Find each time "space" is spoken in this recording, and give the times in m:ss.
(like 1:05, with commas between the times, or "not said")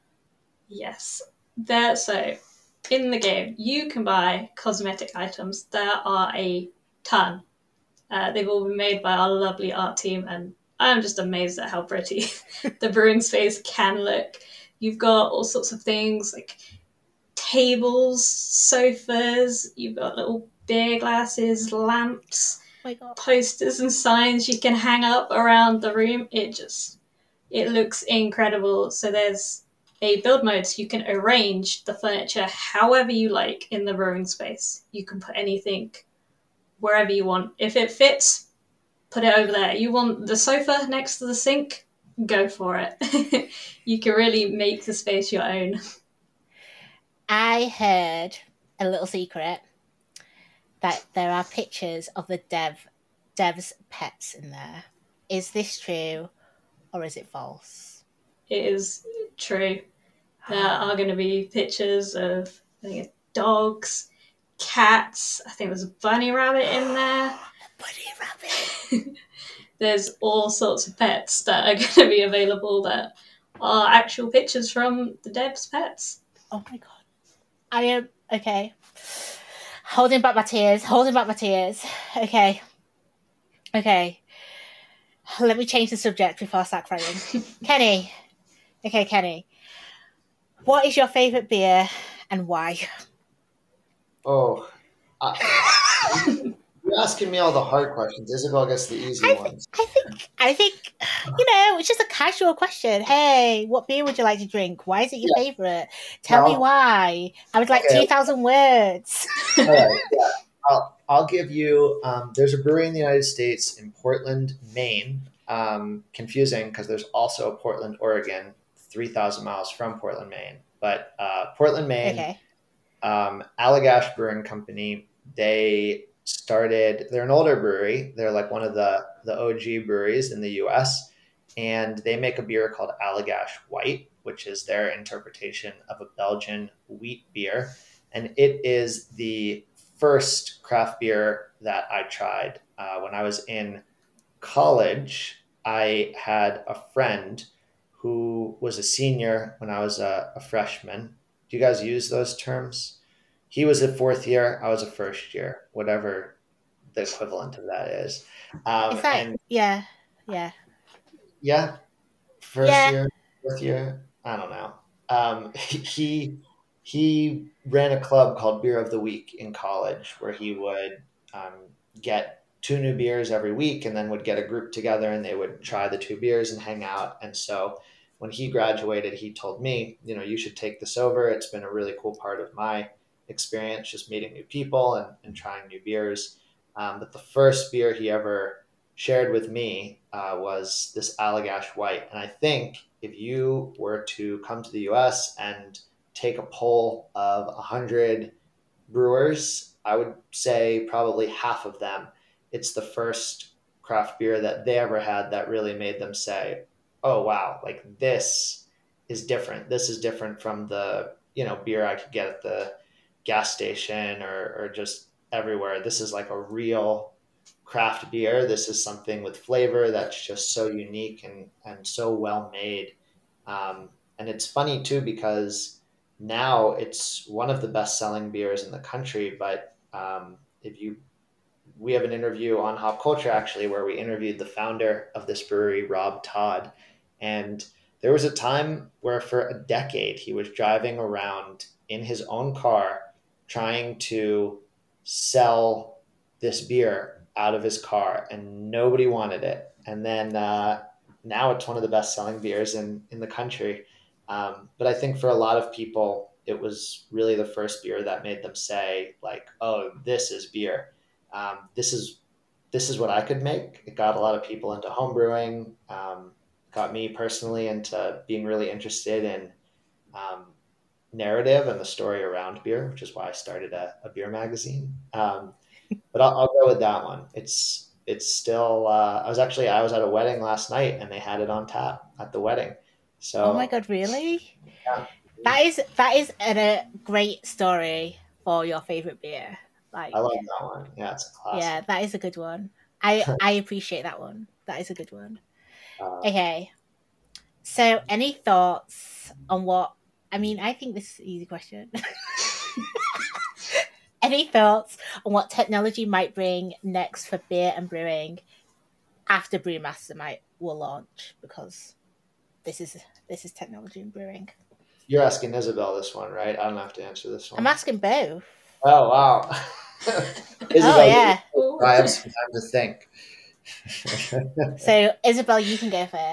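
0:13, 0:34, 0:44.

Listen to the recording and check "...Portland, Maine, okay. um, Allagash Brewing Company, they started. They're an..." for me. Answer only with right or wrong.
right.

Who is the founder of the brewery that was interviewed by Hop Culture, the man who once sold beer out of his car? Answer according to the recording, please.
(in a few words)
Rob Todd.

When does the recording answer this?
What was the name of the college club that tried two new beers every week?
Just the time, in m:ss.
2:48.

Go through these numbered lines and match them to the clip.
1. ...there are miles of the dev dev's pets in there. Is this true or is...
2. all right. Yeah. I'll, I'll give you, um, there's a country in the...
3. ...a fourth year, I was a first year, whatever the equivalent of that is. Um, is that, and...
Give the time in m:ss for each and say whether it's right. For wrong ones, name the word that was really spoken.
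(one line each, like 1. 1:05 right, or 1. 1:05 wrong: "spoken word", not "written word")
1. 0:51 wrong: "pictures", not "miles"
2. 1:49 wrong: "brewery", not "country"
3. 2:33 right.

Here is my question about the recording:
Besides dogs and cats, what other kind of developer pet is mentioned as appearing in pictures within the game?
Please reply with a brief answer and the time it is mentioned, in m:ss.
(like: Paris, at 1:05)
Bunny rabbit, at 1:06.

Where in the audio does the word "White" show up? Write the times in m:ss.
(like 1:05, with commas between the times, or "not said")
2:13, 3:11.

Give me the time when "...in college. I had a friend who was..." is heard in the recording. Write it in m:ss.
2:23.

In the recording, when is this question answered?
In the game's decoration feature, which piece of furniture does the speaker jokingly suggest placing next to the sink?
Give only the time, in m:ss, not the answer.
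0:40.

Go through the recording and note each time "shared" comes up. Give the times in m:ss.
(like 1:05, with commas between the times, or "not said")
3:08.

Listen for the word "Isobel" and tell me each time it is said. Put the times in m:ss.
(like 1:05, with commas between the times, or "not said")
1:38, 5:15, 5:20, 5:25.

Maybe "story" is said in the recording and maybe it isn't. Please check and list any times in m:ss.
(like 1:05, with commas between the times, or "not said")
4:31, 4:47.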